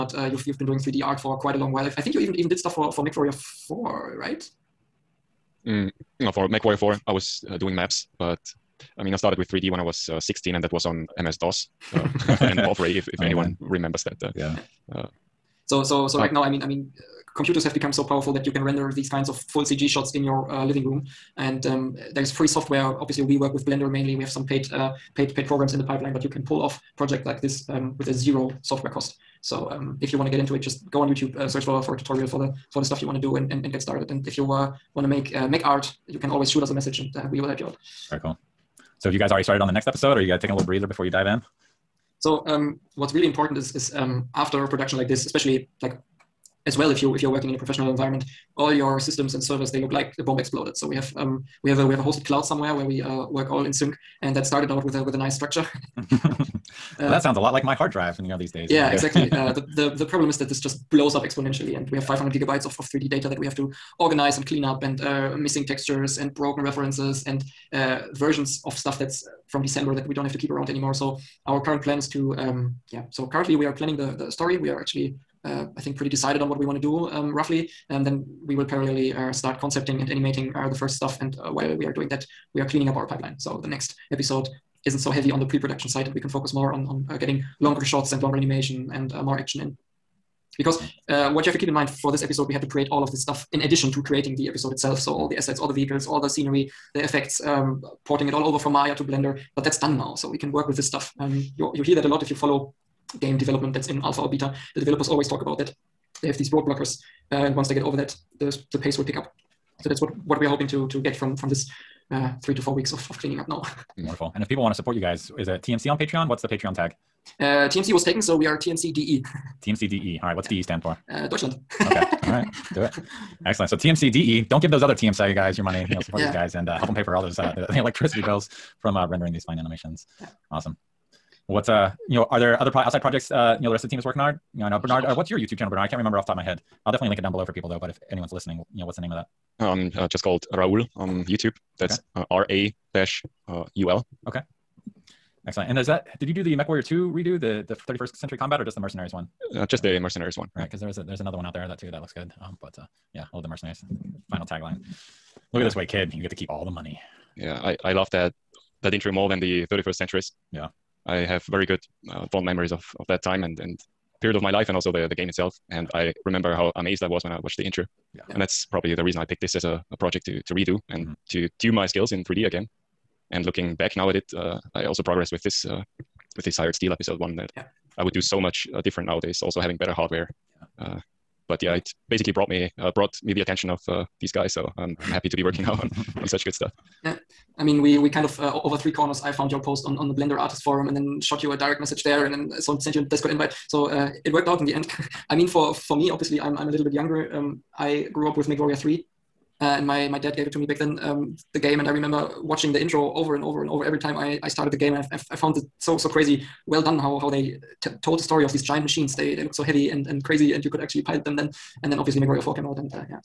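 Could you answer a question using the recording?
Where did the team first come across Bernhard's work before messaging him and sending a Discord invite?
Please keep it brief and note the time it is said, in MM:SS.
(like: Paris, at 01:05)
Blender Artist Forum, at 03:10.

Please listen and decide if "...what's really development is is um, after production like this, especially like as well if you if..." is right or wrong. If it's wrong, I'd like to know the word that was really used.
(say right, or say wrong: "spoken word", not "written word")
wrong: "important", not "development".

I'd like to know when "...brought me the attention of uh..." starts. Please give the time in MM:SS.
03:02.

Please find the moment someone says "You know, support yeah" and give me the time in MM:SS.
02:05.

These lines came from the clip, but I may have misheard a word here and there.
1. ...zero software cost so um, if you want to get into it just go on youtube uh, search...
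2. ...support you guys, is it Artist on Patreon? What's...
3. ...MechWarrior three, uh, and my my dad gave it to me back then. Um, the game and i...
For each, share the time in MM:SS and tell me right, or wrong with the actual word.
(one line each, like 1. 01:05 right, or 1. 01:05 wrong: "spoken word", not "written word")
1. 00:28 right
2. 01:54 wrong: "TMC", not "Artist"
3. 03:18 right.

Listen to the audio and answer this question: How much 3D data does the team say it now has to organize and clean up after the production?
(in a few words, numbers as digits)
500 gigabytes.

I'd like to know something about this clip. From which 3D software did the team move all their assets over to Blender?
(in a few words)
Maya.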